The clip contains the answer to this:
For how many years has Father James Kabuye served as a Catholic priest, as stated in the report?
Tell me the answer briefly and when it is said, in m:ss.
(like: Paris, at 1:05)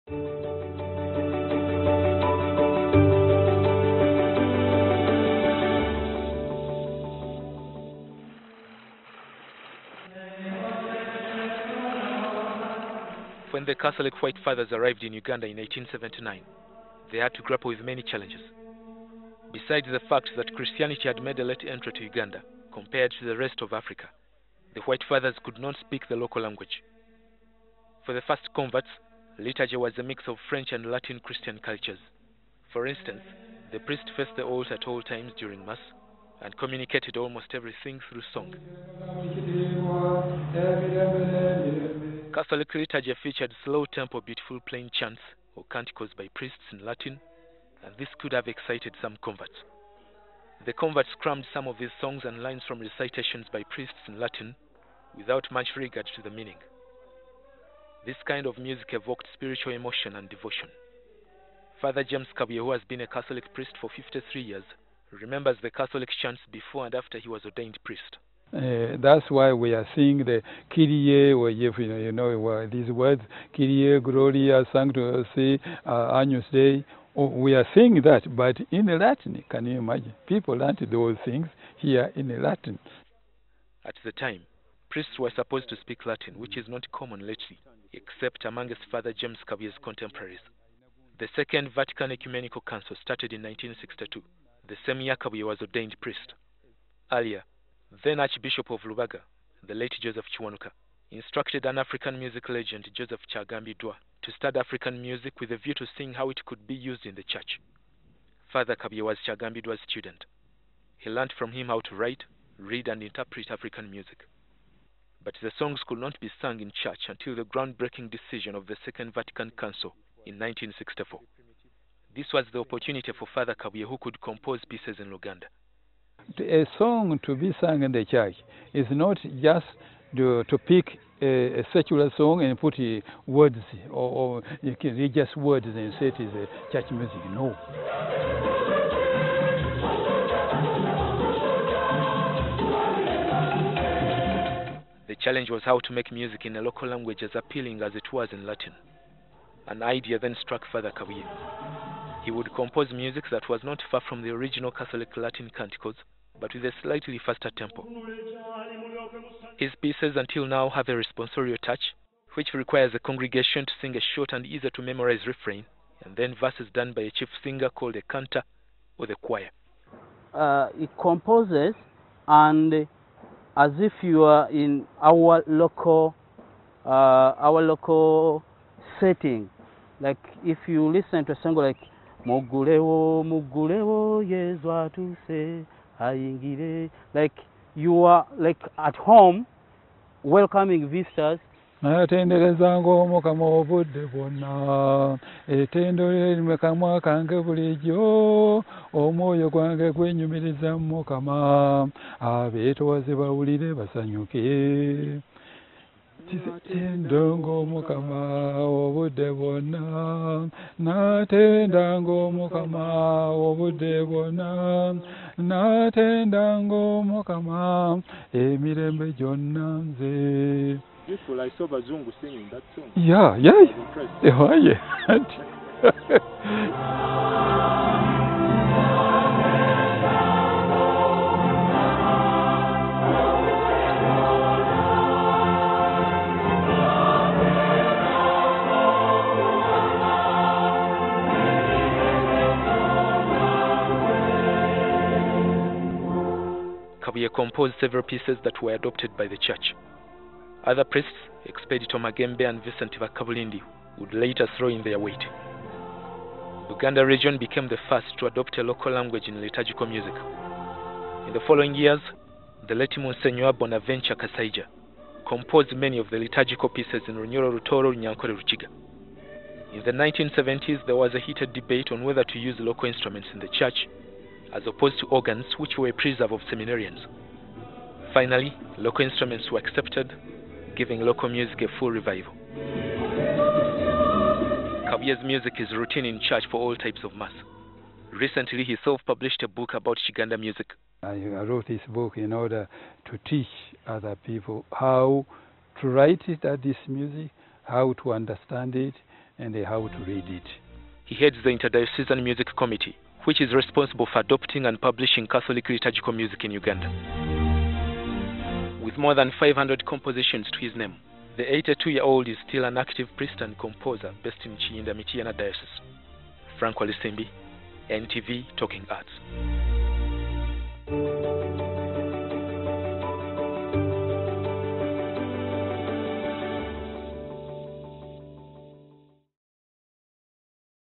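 53, at 1:03.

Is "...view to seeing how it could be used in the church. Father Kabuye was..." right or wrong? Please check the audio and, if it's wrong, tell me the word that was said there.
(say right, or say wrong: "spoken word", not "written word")
right.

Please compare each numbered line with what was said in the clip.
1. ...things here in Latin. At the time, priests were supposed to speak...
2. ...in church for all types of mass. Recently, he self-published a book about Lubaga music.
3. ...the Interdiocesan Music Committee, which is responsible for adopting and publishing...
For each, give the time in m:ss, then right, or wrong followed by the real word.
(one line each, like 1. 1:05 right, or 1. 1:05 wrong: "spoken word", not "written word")
1. 1:21 right
2. 4:46 wrong: "Kiganda", not "Lubaga"
3. 5:01 right.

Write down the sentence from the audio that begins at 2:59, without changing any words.
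Like if you listen to a song like Mugulewo, Mugulewo, to say.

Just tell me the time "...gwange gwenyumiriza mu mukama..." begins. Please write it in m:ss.
3:19.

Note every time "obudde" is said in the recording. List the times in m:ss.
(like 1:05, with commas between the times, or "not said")
3:13, 3:28, 3:33.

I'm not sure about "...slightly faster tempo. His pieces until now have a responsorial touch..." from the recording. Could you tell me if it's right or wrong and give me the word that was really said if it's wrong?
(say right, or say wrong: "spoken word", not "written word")
right.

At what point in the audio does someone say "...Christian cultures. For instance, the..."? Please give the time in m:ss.
0:31.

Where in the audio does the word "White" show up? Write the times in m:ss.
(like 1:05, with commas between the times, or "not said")
0:14, 0:24.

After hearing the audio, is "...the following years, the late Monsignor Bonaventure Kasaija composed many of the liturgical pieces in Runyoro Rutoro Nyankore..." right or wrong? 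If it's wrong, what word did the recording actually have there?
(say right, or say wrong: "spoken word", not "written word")
right.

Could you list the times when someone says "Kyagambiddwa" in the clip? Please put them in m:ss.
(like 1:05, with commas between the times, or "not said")
1:43, 1:49.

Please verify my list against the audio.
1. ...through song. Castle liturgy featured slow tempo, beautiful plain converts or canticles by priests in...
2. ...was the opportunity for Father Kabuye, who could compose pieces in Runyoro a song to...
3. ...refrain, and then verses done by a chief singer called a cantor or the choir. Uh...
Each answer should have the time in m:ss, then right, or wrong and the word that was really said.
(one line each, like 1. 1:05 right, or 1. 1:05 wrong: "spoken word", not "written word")
1. 0:38 wrong: "chants", not "converts"
2. 2:02 wrong: "Luganda", not "Runyoro"
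3. 2:45 right.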